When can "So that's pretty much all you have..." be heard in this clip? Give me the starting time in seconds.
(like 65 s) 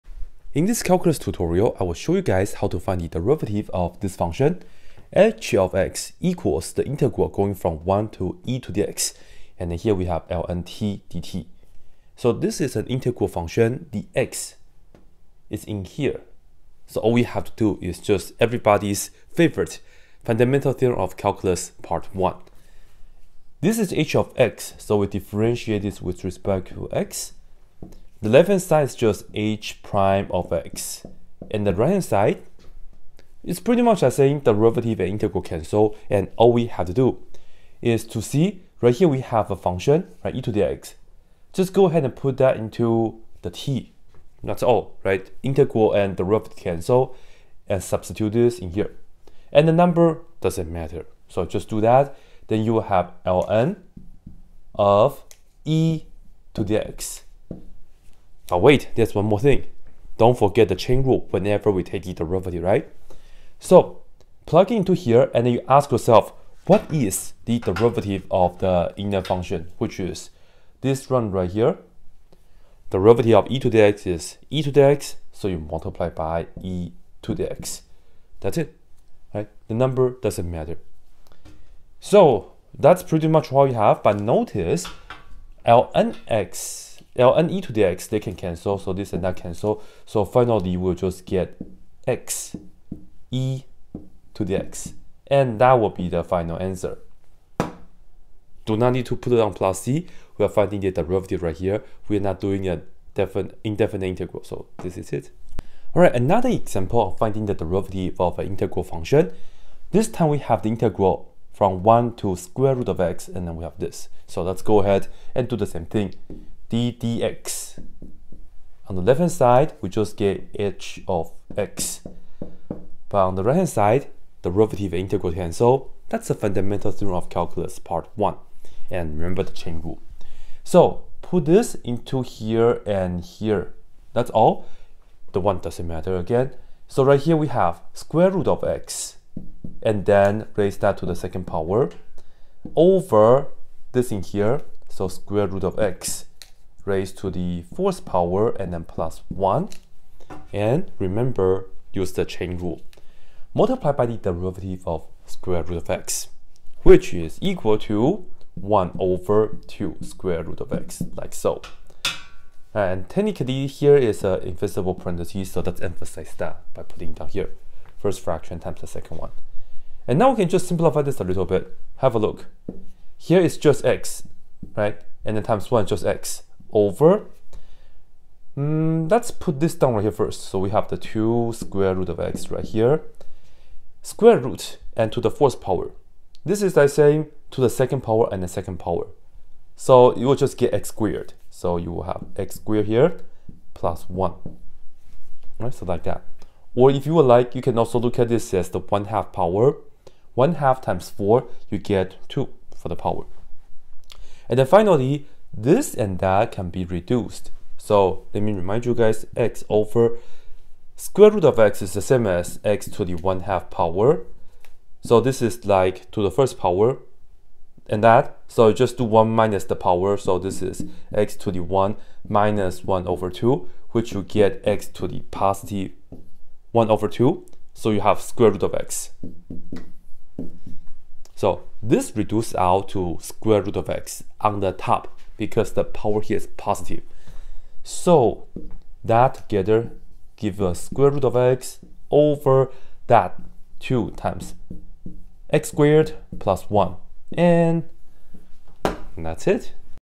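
81 s.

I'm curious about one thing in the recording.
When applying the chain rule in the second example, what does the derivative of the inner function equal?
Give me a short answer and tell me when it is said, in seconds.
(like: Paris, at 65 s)
1 over 2 square root of x, at 158 s.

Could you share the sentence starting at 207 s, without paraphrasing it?
So let me remind you guys, x over square root of x is the same as x to the 1 half power.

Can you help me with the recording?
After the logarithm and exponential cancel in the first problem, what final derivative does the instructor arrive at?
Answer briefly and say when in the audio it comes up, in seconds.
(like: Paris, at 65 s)
x e to the x, at 92 s.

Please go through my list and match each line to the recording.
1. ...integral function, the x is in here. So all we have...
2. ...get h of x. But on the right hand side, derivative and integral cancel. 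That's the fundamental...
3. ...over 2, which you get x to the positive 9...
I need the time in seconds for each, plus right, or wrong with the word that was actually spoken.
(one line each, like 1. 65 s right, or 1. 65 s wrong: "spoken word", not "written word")
1. 12 s right
2. 120 s right
3. 223 s wrong: "1", not "9".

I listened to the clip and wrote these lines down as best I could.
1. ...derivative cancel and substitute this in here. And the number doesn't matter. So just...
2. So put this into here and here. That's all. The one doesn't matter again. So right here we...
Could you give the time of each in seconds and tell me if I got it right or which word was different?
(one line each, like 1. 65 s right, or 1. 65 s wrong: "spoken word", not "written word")
1. 46 s right
2. 130 s right.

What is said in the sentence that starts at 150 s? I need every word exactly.
And remember, use the chain rule.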